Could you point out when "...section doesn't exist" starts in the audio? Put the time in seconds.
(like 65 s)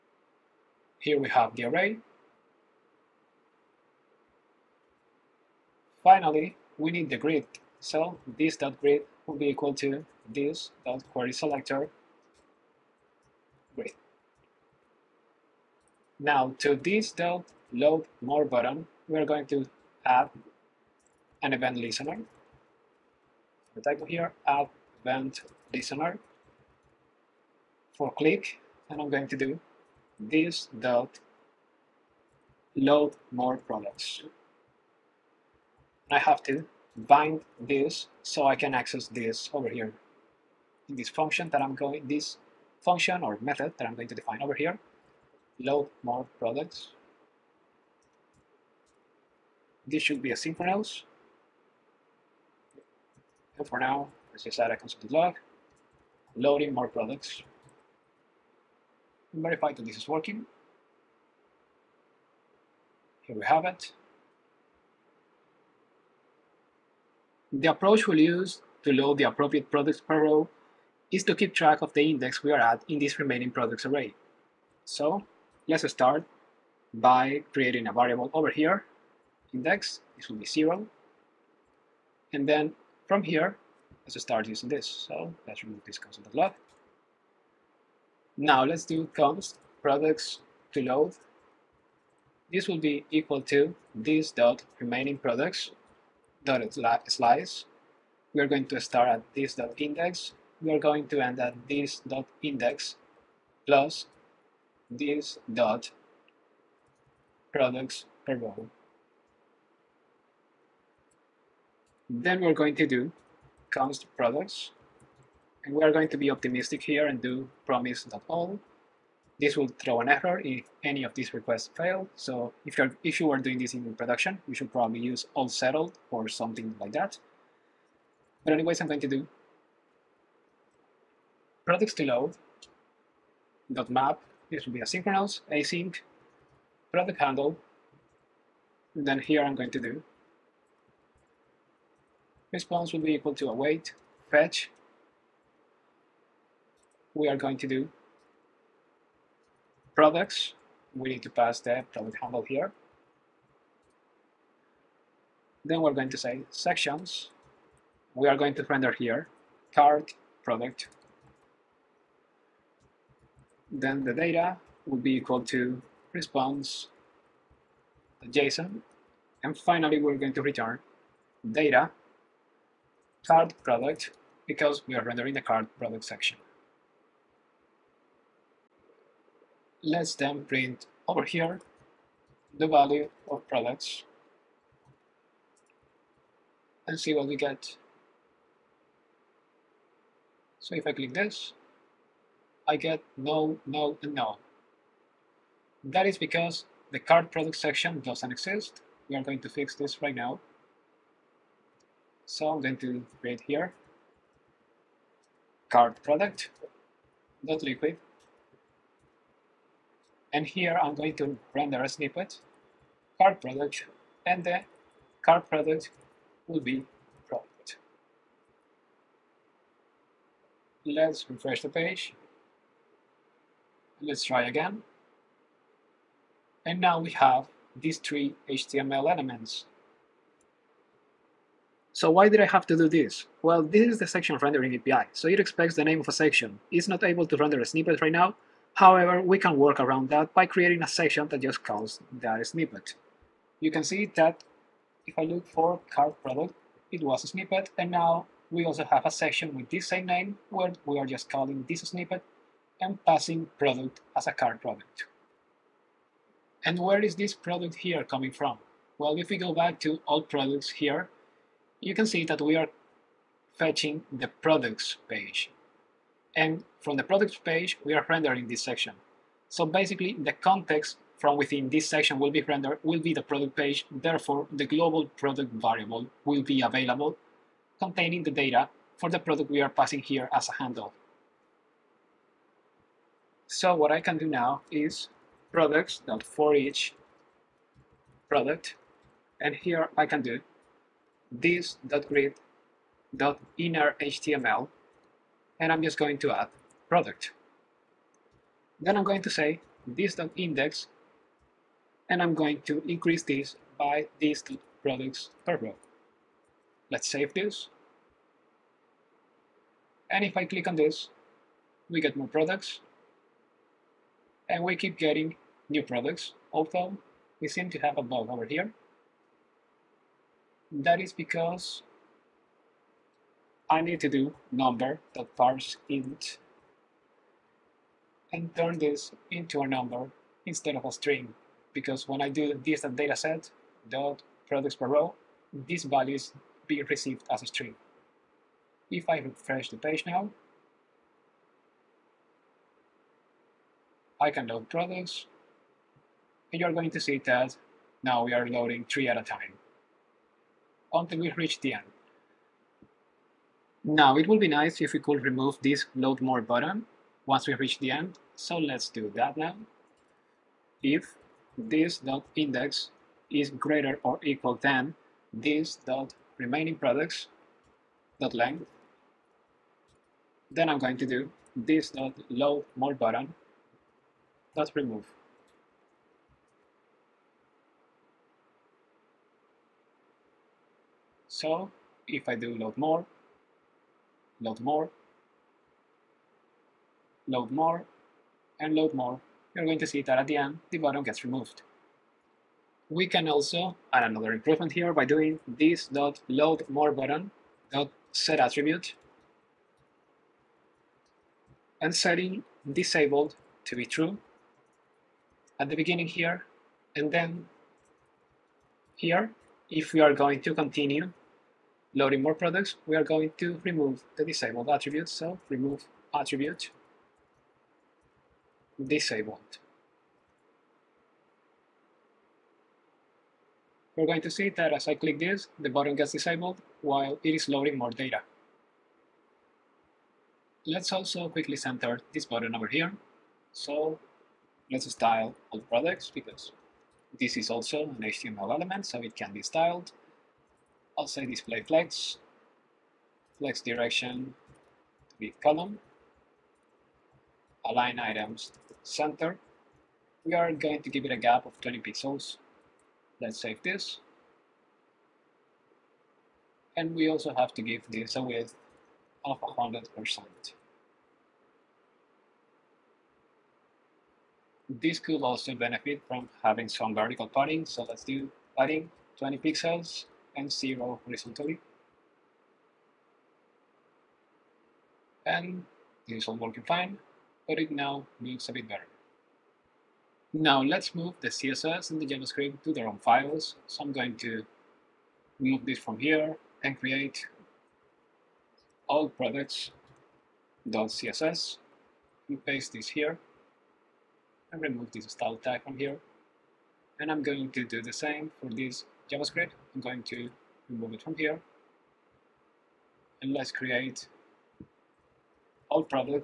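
197 s.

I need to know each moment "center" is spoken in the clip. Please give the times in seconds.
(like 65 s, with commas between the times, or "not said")
431 s, 448 s.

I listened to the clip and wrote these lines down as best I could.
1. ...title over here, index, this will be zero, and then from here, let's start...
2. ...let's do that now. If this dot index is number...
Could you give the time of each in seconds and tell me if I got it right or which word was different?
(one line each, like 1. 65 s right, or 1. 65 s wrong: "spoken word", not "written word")
1. 77 s wrong: "variable", not "title"
2. 358 s wrong: "greater", not "number".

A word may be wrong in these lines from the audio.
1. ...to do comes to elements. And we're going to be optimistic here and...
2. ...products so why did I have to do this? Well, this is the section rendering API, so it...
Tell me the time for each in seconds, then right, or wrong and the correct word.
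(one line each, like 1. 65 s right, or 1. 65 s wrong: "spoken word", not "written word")
1. 112 s wrong: "products", not "elements"
2. 229 s wrong: "elements", not "products".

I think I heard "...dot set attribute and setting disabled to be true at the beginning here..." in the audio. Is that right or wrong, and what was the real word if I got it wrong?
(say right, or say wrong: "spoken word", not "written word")
right.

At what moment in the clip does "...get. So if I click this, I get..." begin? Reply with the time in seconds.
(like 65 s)
187 s.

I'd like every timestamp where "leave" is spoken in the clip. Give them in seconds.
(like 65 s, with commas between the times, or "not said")
not said.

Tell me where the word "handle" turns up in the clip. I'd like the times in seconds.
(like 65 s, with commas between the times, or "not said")
137 s, 152 s, 280 s.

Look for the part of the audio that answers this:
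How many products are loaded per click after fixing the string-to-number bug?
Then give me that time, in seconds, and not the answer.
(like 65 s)
348 s.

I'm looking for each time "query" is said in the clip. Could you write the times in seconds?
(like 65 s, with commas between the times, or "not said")
11 s.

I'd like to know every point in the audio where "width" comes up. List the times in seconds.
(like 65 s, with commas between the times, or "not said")
458 s.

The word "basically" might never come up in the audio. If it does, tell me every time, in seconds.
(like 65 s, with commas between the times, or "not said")
269 s.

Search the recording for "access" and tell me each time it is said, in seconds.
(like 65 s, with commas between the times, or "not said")
38 s.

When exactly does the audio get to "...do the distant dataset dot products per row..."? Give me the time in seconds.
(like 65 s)
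332 s.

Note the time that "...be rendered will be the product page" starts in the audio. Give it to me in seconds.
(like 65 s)
272 s.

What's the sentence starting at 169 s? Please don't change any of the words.
And finally, we're going to return data card product because we are rendering the card product section.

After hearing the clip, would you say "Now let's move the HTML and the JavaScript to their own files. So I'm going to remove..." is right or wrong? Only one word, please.
wrong.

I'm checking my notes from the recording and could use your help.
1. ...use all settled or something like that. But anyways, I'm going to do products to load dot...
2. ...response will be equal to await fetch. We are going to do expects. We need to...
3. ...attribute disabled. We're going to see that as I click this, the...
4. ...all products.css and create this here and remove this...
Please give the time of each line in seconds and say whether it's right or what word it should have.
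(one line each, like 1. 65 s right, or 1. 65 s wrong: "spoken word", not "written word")
1. 125 s right
2. 142 s wrong: "products", not "expects"
3. 416 s right
4. 488 s wrong: "paste", not "create".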